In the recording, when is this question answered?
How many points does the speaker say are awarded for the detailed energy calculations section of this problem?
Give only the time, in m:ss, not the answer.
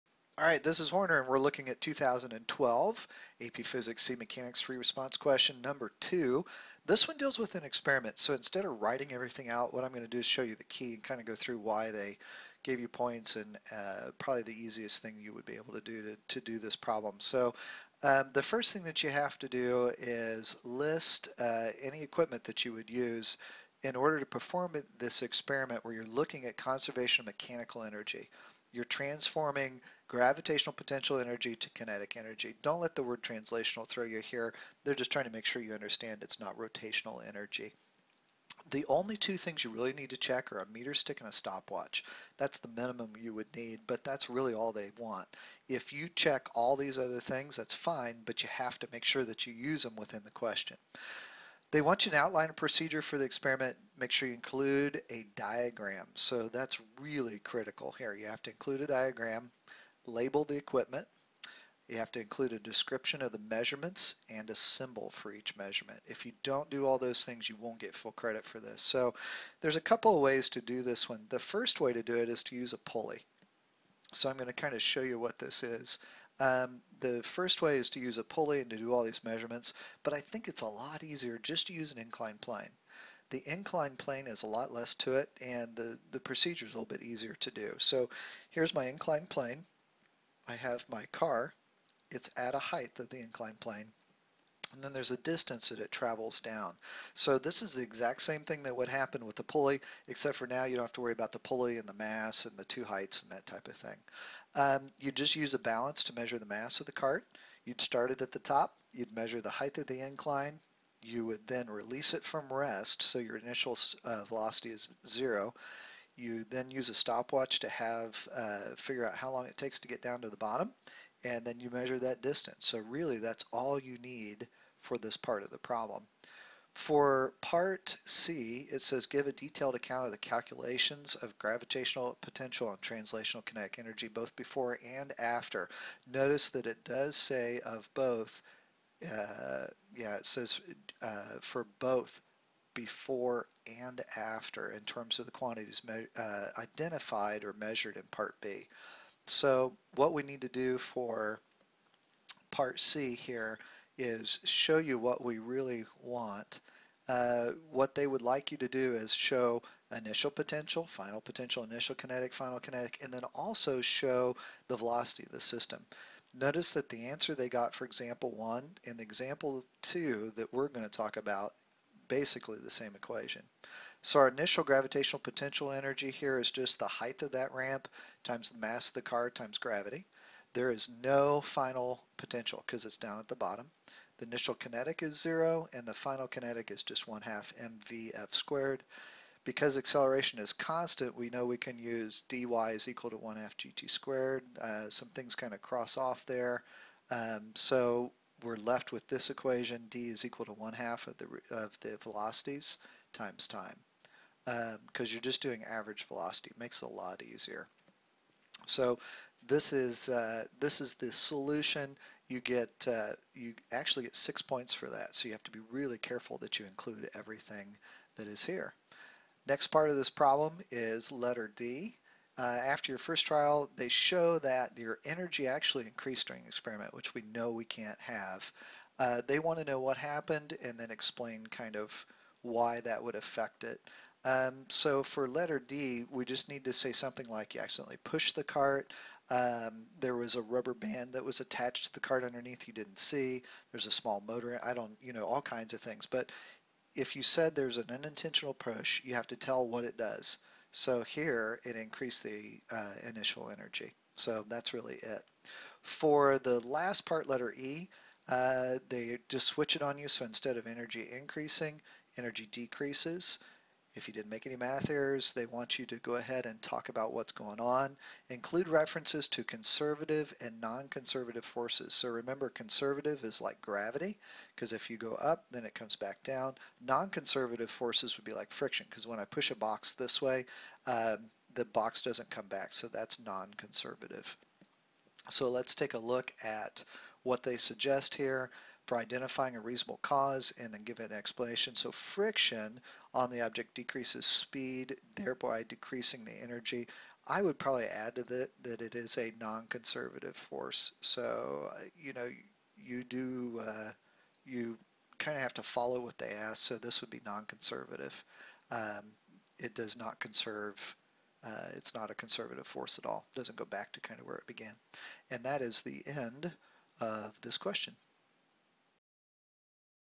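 3:34.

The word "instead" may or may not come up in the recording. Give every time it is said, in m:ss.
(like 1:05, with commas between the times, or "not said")
0:08, 4:20.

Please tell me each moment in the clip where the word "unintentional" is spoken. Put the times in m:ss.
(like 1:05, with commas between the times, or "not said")
4:07.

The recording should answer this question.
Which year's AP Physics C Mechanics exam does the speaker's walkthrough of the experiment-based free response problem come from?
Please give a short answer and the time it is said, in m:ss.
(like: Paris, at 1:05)
2012, at 0:01.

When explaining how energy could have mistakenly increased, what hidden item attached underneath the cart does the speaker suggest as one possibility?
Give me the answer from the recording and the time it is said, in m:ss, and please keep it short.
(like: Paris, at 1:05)
rubber band, at 4:00.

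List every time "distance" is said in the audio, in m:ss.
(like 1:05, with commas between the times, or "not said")
1:35, 2:02.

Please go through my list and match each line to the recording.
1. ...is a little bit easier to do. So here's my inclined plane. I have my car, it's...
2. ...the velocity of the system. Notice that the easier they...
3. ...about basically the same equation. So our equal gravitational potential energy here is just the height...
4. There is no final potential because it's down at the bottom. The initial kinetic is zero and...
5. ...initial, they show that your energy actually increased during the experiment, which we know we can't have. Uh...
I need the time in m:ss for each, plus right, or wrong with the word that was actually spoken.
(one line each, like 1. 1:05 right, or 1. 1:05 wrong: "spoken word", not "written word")
1. 1:26 right
2. 2:44 wrong: "answer", not "easier"
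3. 2:51 wrong: "initial", not "equal"
4. 3:00 right
5. 3:43 wrong: "trial", not "initial".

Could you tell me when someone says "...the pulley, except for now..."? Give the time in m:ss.
1:39.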